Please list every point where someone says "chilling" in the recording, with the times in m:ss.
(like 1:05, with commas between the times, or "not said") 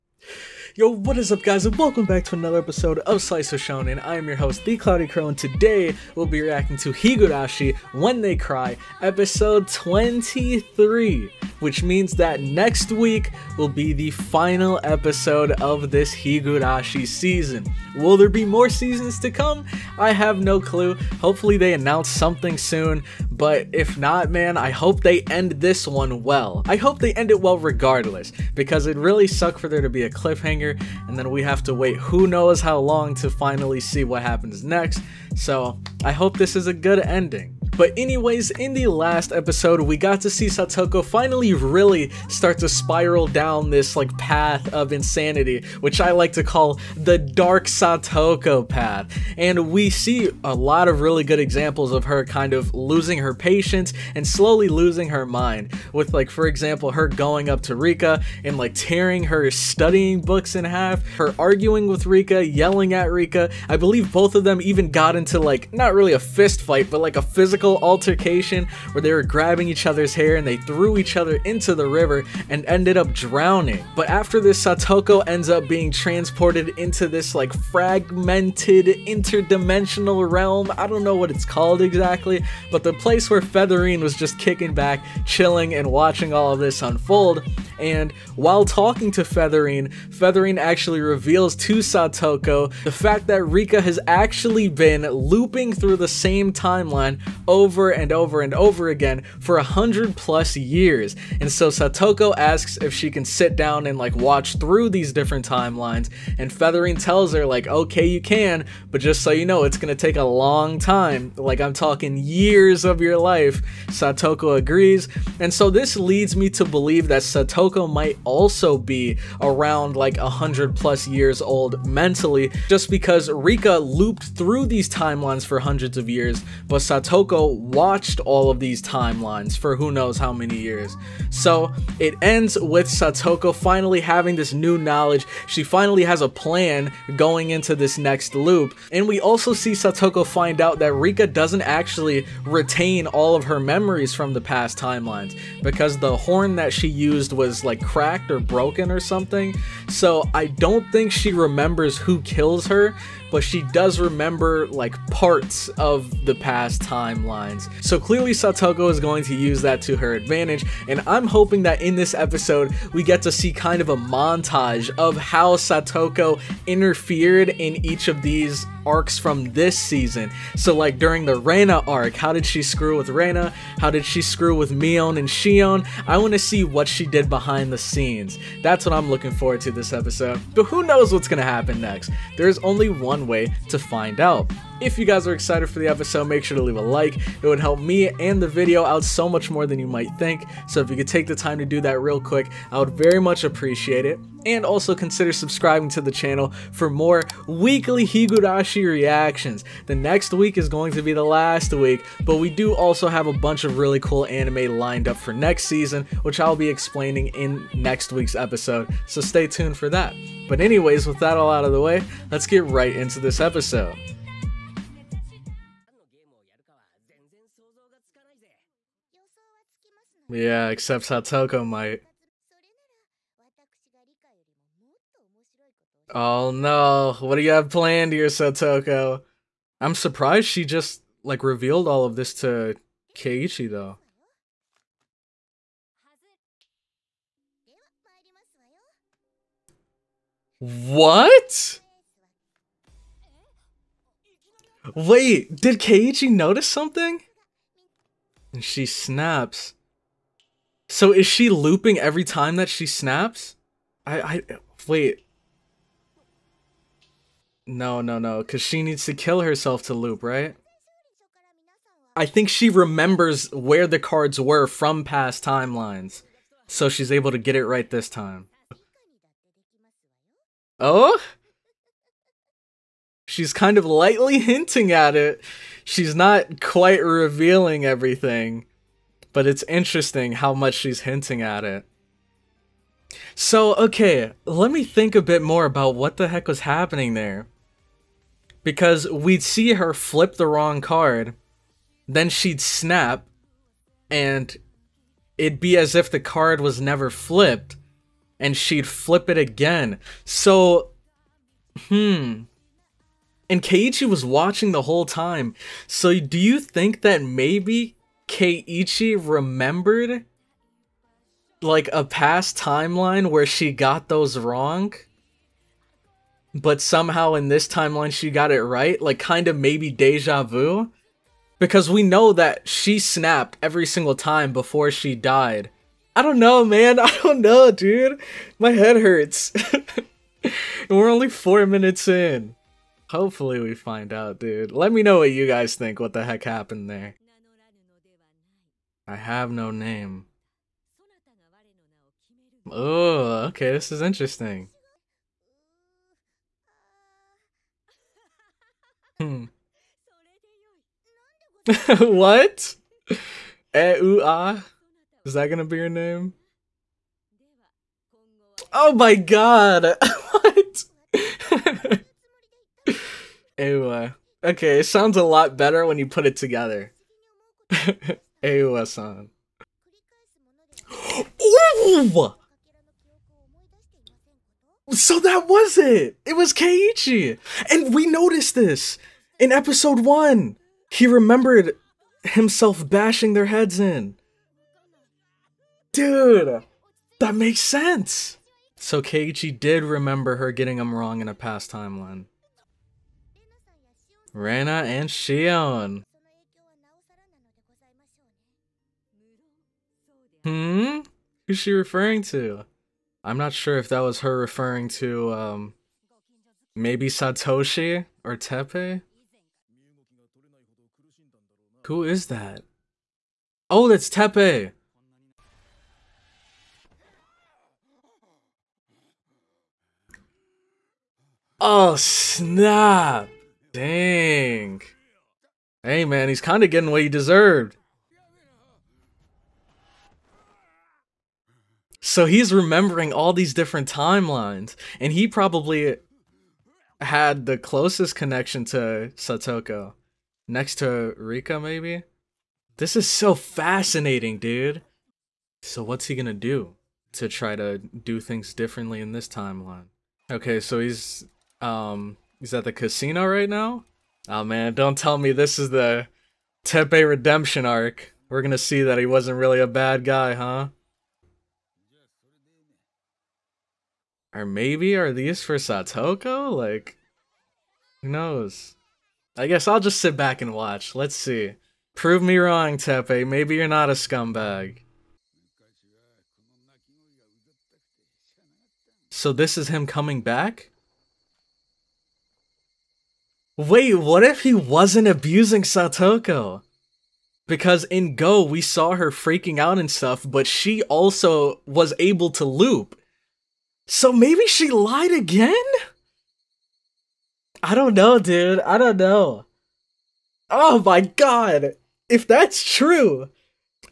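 1:25.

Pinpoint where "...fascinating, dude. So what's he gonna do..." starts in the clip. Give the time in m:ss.
7:23.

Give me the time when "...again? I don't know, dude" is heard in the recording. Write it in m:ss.
8:15.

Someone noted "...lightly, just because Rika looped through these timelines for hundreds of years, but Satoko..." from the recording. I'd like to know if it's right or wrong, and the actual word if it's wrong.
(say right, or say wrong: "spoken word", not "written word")
wrong: "mentally", not "lightly".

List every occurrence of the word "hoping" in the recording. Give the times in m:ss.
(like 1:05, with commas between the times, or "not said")
2:41.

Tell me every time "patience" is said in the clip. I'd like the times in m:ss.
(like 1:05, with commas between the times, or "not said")
0:53.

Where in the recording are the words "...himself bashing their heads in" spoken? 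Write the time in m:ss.
6:22.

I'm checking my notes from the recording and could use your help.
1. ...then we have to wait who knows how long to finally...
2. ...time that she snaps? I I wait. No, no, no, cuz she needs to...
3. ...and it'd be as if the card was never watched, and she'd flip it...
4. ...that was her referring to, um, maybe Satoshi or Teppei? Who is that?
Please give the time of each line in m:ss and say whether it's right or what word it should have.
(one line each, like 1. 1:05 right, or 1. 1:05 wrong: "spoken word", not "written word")
1. 0:31 right
2. 4:12 right
3. 4:54 wrong: "flipped", not "watched"
4. 6:43 right.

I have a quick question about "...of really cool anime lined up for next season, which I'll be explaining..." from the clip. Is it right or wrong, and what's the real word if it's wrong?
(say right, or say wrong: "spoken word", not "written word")
right.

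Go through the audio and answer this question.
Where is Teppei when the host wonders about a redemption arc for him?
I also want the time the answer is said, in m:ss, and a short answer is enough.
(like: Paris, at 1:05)
the casino, at 7:32.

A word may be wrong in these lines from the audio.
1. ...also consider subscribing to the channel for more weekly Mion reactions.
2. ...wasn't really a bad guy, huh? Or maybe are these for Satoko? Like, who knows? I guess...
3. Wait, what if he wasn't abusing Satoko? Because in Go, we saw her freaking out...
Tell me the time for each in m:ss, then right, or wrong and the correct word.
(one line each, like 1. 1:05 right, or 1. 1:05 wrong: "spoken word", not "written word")
1. 3:14 wrong: "Higurashi", not "Mion"
2. 7:39 right
3. 8:03 right.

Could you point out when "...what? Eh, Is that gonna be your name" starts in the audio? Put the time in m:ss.
5:51.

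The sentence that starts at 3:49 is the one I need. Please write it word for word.
I'm surprised she just, like, revealed all of this to Keiichi, though.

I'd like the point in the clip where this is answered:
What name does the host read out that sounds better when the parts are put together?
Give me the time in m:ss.
6:08.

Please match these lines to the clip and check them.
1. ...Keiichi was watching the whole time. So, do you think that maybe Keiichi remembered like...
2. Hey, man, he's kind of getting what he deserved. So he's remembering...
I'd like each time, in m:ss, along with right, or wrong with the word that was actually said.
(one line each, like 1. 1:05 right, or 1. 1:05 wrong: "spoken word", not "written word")
1. 5:03 right
2. 7:05 right.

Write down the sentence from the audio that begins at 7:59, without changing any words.
So this is him coming back?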